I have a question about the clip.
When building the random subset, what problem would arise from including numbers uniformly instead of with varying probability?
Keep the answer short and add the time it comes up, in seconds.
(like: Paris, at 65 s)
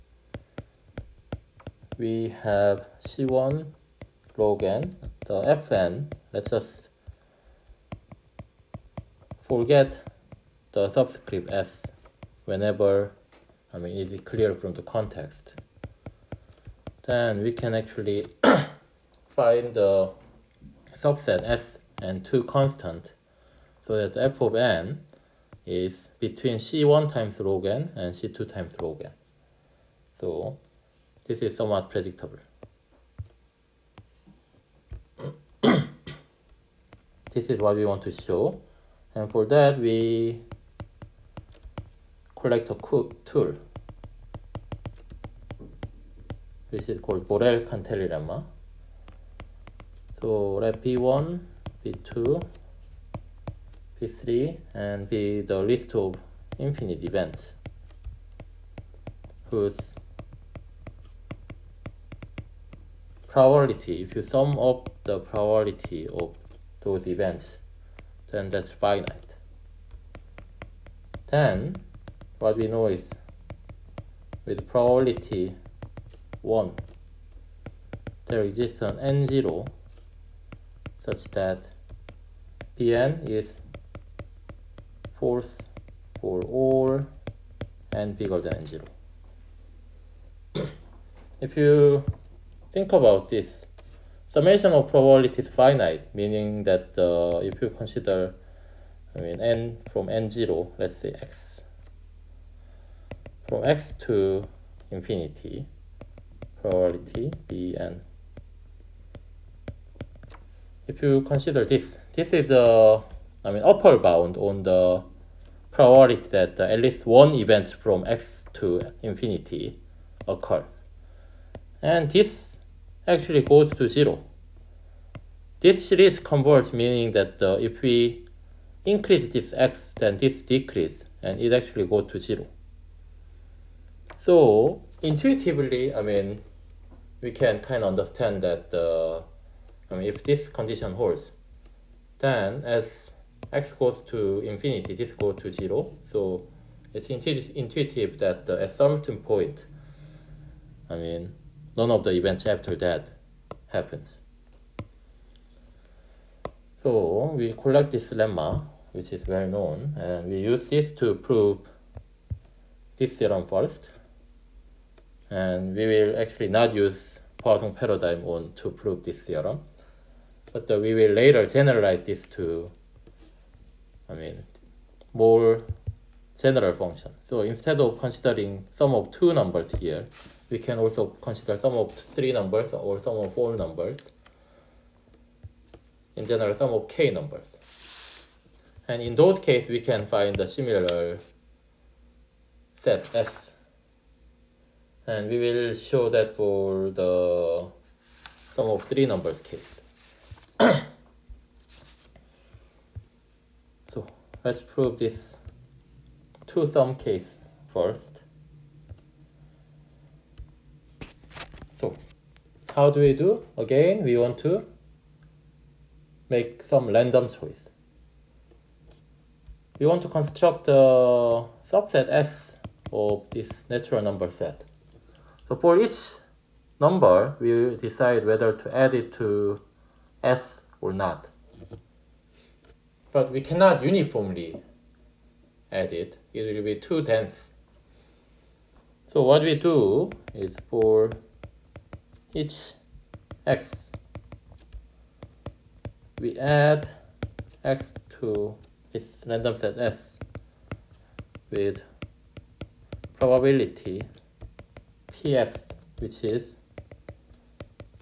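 Too dense, at 236 s.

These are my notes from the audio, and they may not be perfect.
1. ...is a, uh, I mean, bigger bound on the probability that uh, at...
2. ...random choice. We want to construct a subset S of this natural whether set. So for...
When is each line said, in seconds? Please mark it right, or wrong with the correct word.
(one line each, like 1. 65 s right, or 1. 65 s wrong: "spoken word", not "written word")
1. 112 s wrong: "upper", not "bigger"
2. 216 s wrong: "number", not "whether".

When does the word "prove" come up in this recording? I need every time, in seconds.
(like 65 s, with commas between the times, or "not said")
161 s, 168 s, 204 s.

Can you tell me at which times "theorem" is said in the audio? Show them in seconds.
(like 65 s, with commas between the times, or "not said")
163 s, 169 s.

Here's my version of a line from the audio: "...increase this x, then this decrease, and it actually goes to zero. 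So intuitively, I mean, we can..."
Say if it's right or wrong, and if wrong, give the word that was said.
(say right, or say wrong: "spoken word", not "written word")
right.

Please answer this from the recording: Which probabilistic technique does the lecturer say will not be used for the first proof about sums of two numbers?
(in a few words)
Poisson paradigm.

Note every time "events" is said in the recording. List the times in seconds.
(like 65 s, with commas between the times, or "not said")
57 s, 67 s, 117 s, 152 s.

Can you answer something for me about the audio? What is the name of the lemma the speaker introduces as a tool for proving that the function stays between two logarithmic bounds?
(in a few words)
Borel-Cantelli lemma.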